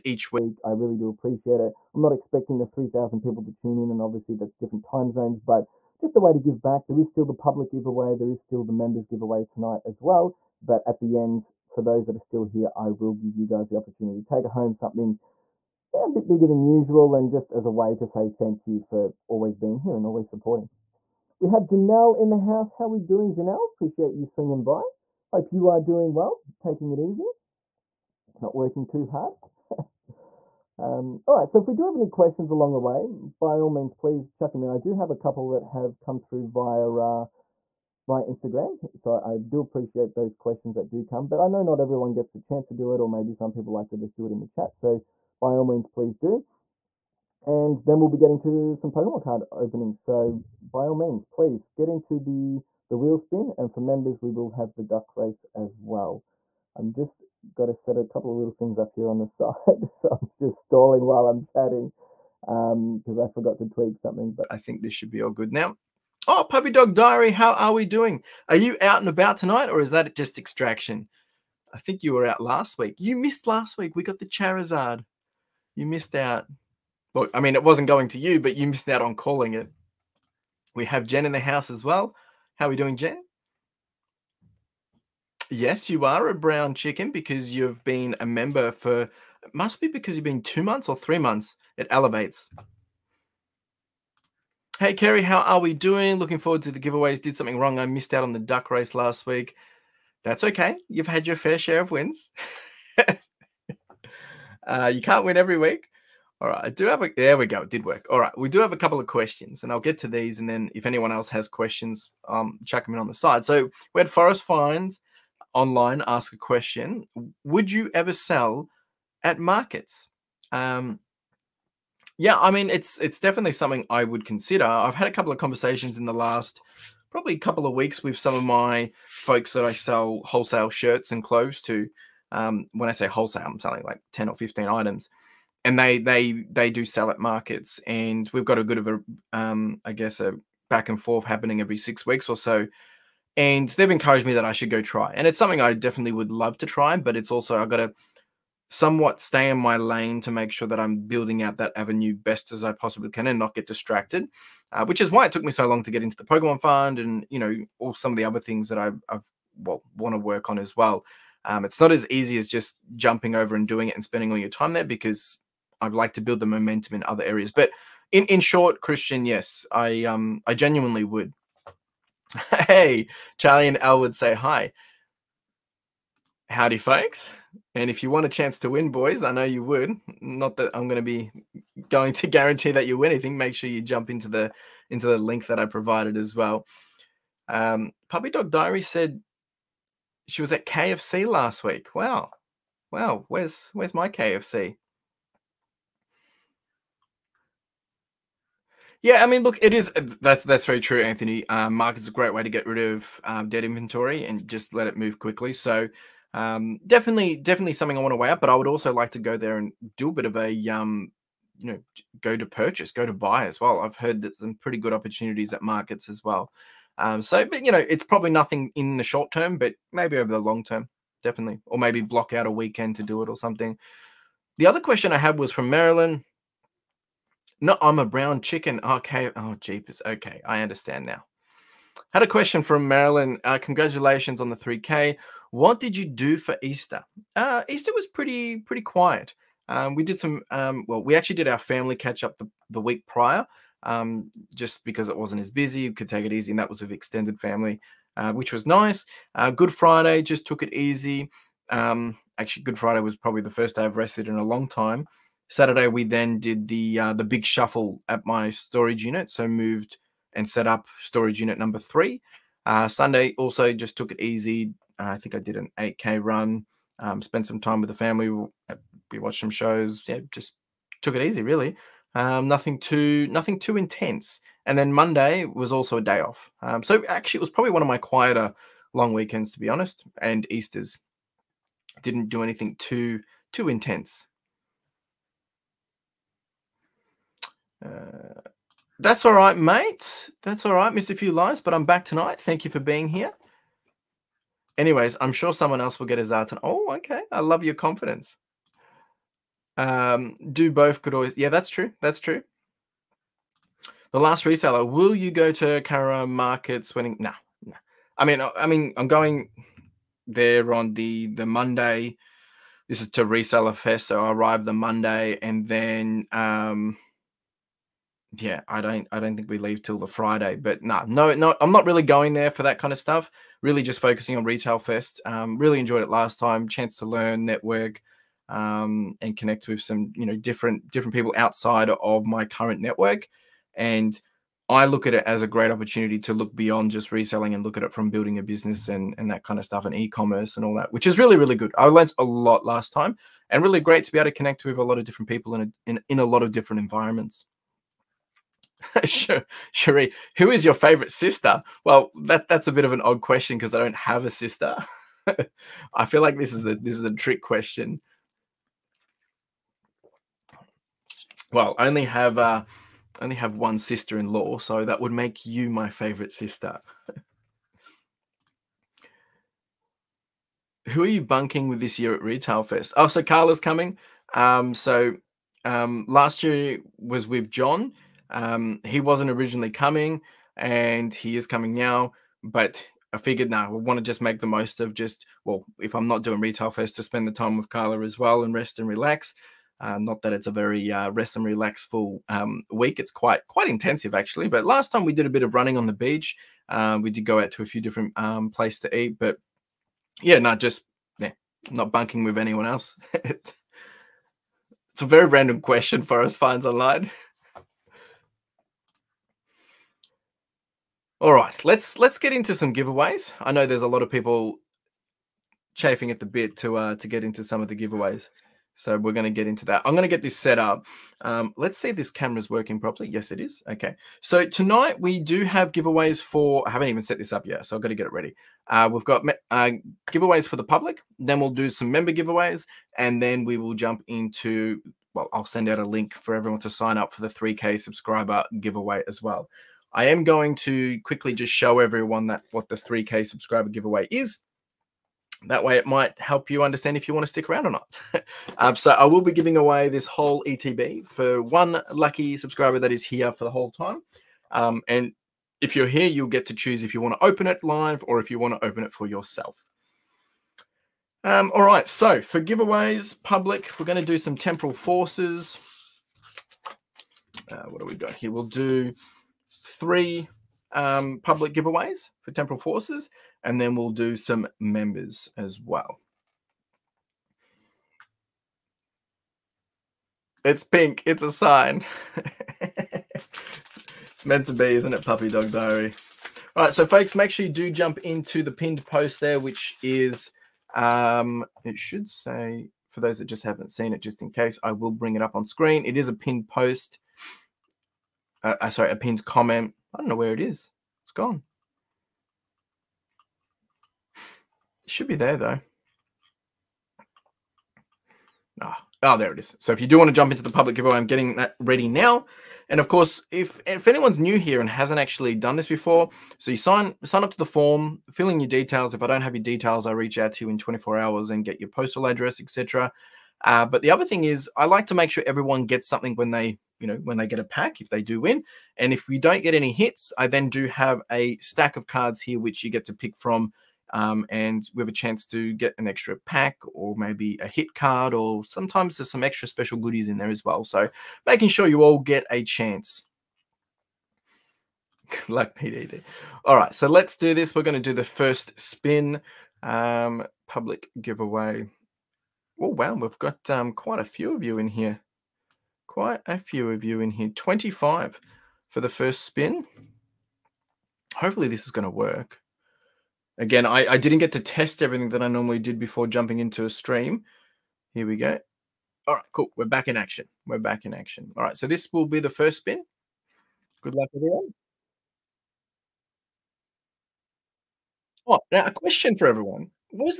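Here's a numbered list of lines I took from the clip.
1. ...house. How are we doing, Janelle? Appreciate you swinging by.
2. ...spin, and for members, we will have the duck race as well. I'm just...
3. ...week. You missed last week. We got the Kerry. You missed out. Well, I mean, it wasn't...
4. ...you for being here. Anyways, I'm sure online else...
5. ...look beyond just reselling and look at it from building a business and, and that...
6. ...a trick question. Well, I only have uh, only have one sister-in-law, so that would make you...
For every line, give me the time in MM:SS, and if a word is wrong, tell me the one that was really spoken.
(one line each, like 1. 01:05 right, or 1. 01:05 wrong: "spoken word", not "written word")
1. 00:22 right
2. 00:53 right
3. 01:12 wrong: "Charizard", not "Kerry"
4. 04:52 wrong: "someone", not "online"
5. 05:36 right
6. 05:57 right.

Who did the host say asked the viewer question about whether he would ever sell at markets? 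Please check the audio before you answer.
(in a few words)
Forest Finds.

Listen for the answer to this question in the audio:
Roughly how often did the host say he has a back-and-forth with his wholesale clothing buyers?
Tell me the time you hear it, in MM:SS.
02:21.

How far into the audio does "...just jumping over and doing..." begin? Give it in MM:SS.
02:42.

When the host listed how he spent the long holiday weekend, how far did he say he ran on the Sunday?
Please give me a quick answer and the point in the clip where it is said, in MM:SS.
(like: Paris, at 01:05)
8K, at 04:25.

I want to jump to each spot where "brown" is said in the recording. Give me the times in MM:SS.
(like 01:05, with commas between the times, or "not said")
01:26, 03:48.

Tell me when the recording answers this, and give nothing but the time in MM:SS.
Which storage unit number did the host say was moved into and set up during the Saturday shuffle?
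04:21.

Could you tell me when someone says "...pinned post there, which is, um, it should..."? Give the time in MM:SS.
08:08.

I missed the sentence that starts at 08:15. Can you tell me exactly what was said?
It is a pinned post, uh, uh sorry, a pinned comment I don't know where it is.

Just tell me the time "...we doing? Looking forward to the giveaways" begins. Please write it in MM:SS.
01:35.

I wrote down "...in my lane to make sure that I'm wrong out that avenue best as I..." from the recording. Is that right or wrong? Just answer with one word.
wrong.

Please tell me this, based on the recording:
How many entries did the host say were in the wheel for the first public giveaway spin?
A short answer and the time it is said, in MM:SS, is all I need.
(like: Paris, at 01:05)
25, at 09:17.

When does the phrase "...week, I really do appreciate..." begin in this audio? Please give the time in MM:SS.
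00:00.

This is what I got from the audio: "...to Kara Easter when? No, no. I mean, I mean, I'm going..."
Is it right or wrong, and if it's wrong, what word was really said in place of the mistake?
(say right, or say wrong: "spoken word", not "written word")
wrong: "Markets", not "Easter".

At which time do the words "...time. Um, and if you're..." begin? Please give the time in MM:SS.
07:33.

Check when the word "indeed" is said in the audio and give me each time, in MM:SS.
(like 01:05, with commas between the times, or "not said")
not said.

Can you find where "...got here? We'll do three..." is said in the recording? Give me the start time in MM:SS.
07:47.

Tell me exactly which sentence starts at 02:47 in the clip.
But in in short, Christian, yes, I um I genuinely would.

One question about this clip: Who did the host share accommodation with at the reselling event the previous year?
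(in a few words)
John.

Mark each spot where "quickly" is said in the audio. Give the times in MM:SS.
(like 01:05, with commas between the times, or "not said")
03:25, 07:21.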